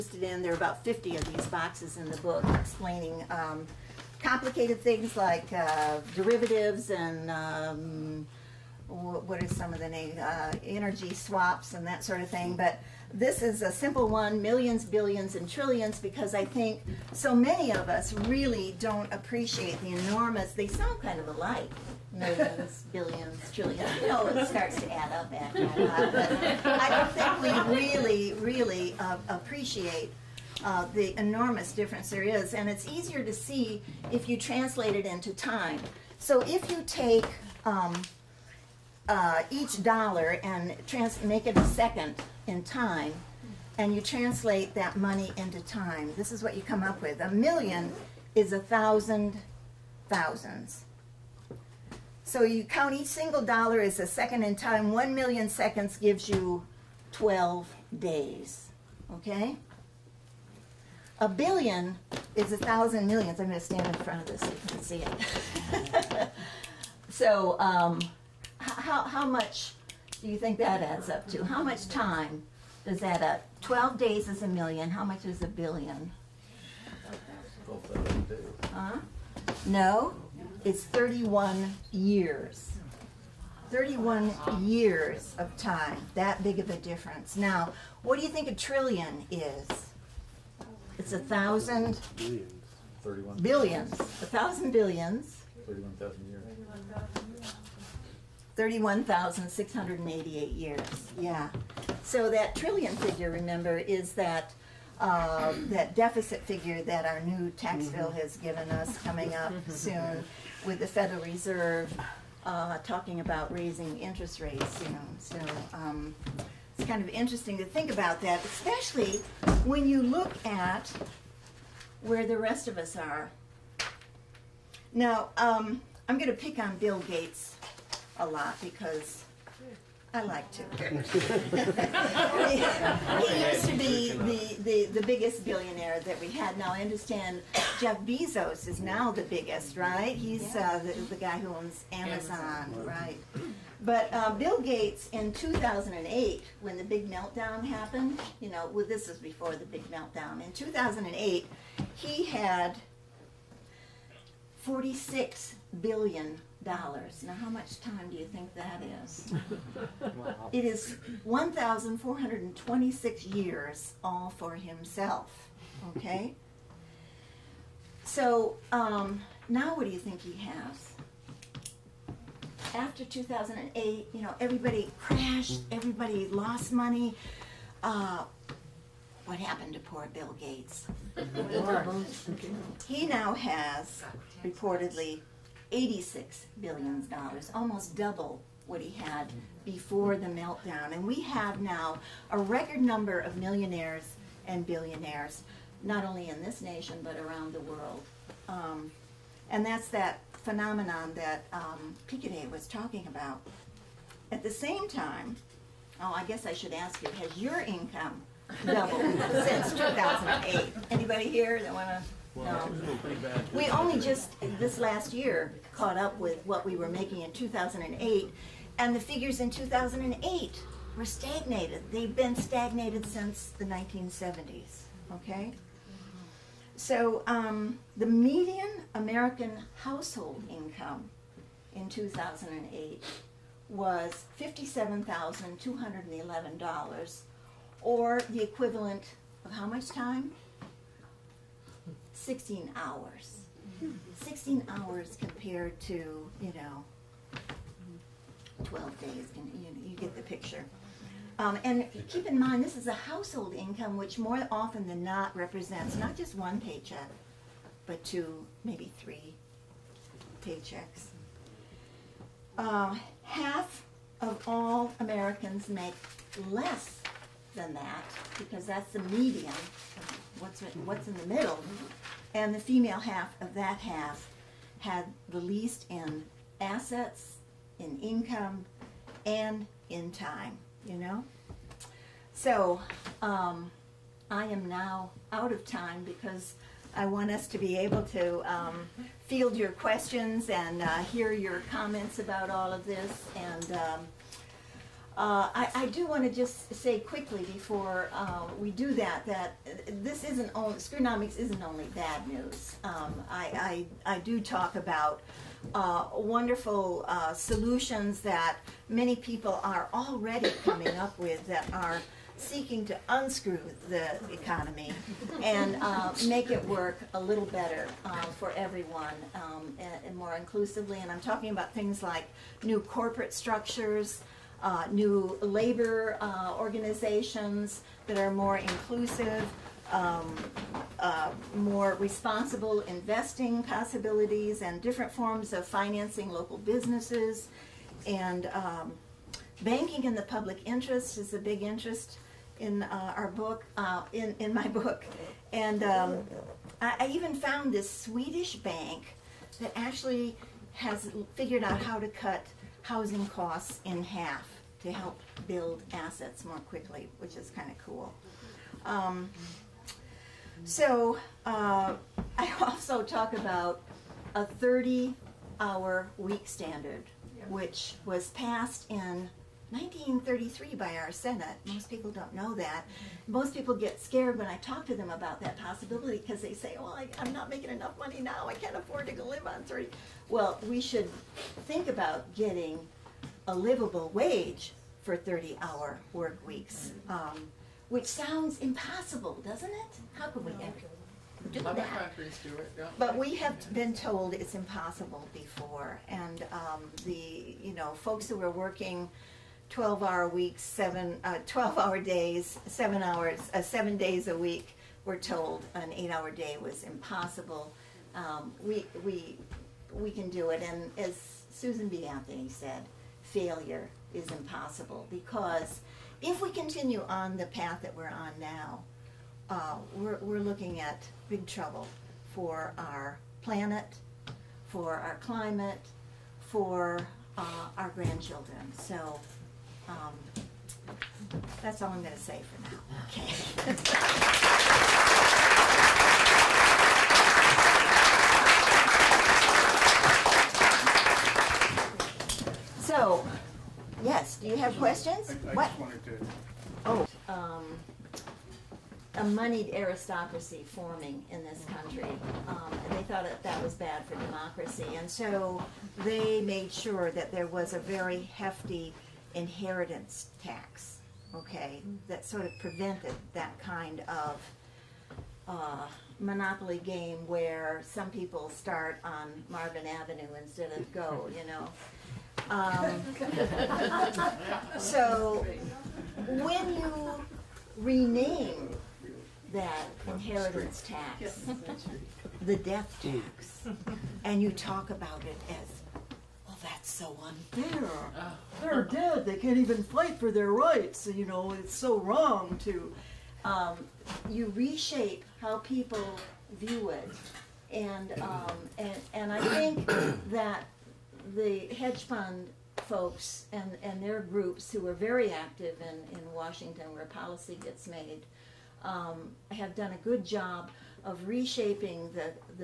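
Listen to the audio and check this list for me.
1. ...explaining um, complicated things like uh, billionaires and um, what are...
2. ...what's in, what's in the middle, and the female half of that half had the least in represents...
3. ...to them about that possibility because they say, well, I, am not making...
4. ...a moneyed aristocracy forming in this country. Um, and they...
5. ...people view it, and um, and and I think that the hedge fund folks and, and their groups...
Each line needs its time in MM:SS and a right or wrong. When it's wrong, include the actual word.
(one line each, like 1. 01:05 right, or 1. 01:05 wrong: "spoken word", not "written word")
1. 00:02 wrong: "derivatives", not "billionaires"
2. 04:30 wrong: "assets", not "represents"
3. 06:14 right
4. 07:29 right
5. 08:15 right.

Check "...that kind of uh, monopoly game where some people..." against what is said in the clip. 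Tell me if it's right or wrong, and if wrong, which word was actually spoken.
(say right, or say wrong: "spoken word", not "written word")
right.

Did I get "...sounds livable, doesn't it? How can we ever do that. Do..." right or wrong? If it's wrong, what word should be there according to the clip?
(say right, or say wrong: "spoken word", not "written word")
wrong: "impossible", not "livable".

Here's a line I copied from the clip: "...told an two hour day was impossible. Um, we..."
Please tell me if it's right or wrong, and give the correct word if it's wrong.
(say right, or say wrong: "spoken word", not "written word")
wrong: "eight", not "two".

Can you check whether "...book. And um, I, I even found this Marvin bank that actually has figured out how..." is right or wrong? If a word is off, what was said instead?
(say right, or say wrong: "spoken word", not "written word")
wrong: "Swedish", not "Marvin".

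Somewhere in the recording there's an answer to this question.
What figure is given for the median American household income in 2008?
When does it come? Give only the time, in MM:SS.
03:54.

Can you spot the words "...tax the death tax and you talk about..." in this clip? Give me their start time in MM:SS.
08:00.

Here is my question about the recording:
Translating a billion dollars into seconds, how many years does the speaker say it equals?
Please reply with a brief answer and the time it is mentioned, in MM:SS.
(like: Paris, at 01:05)
31 years, at 01:20.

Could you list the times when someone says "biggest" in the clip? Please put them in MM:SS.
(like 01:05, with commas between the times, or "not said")
02:15, 02:19.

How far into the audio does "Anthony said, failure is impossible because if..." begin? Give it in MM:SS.
06:52.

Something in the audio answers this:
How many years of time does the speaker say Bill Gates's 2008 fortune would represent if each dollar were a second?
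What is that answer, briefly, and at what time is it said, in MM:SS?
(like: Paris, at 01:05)
1,426 years, at 02:41.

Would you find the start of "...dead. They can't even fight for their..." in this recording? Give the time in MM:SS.
08:08.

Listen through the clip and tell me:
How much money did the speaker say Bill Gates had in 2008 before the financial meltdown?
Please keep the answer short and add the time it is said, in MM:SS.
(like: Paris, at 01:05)
$46 billion, at 02:34.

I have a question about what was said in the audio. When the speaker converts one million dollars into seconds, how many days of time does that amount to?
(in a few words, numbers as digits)
12 days.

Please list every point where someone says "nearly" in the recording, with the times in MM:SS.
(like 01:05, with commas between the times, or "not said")
not said.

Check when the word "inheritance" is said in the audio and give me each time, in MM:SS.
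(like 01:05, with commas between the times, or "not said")
07:39, 08:00.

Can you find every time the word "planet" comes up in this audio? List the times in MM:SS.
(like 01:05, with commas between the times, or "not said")
07:03.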